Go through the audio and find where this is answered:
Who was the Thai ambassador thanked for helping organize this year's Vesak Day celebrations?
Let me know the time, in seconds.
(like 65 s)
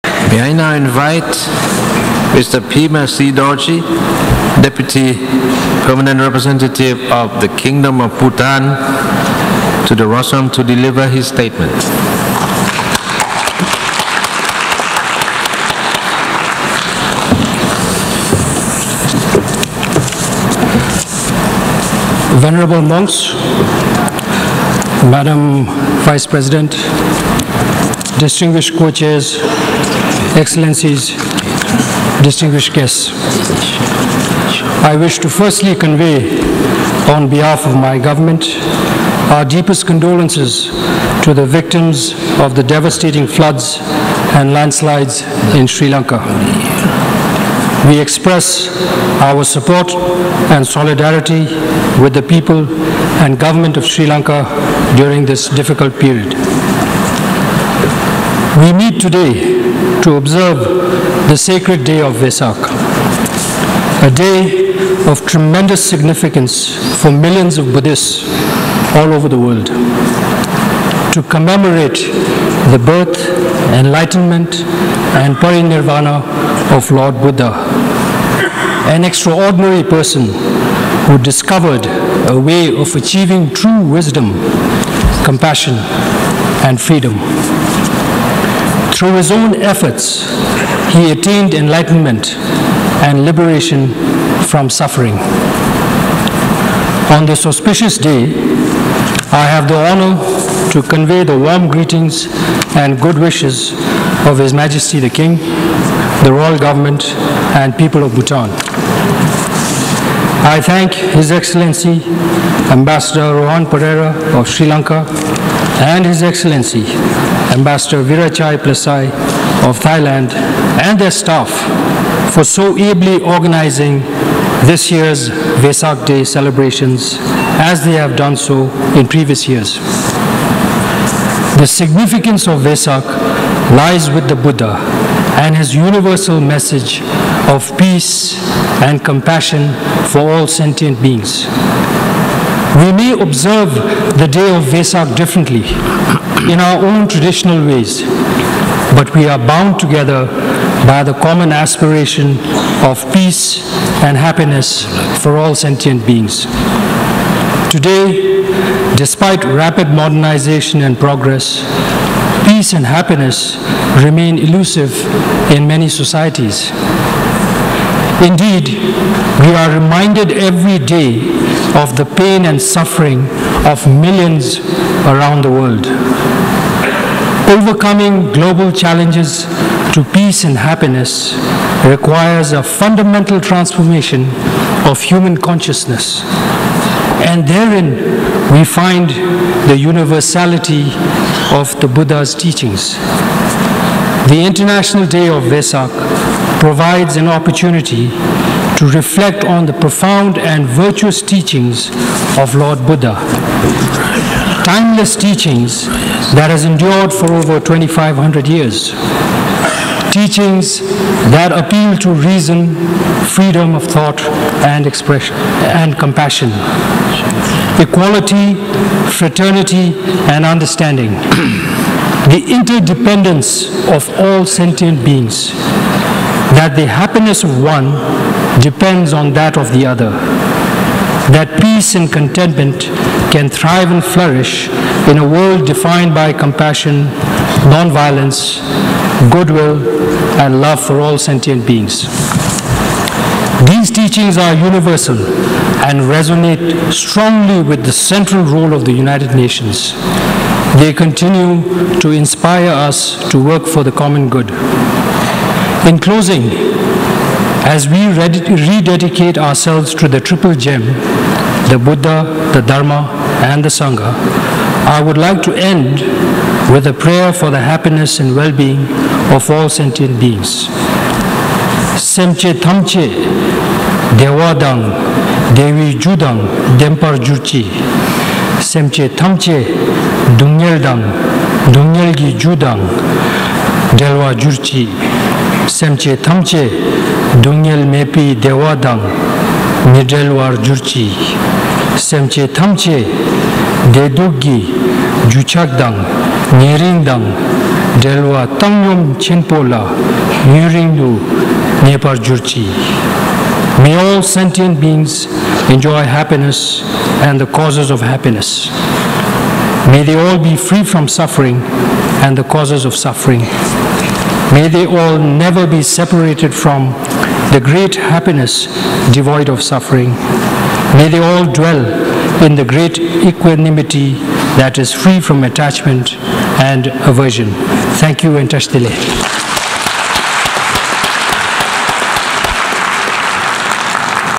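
118 s.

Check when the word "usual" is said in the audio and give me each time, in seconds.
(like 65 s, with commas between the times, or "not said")
not said.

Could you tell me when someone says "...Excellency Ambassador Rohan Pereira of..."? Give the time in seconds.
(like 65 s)
111 s.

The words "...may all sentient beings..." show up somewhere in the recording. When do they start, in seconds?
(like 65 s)
303 s.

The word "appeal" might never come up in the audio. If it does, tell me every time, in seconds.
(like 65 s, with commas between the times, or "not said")
211 s.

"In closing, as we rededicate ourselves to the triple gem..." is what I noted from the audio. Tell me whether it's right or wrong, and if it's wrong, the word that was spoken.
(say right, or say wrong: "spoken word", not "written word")
right.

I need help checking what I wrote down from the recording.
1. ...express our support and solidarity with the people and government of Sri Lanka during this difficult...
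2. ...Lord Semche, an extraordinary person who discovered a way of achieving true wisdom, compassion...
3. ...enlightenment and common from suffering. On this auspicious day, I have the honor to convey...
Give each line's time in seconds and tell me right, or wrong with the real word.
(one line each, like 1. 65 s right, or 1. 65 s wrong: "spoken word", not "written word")
1. 47 s right
2. 76 s wrong: "Buddha", not "Semche"
3. 91 s wrong: "liberation", not "common".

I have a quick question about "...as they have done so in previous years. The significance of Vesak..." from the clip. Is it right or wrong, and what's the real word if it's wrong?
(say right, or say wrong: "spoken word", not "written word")
right.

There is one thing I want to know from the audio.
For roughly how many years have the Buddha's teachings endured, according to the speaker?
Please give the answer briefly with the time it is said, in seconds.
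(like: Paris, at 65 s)
over 2500 years, at 207 s.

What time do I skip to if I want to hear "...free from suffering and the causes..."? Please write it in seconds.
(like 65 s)
310 s.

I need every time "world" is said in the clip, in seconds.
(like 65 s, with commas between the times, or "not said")
69 s, 175 s, 235 s.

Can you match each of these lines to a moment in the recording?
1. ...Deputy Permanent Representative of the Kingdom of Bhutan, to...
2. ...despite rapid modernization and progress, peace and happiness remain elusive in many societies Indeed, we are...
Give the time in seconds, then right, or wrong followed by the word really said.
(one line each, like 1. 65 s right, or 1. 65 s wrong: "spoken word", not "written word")
1. 4 s right
2. 158 s right.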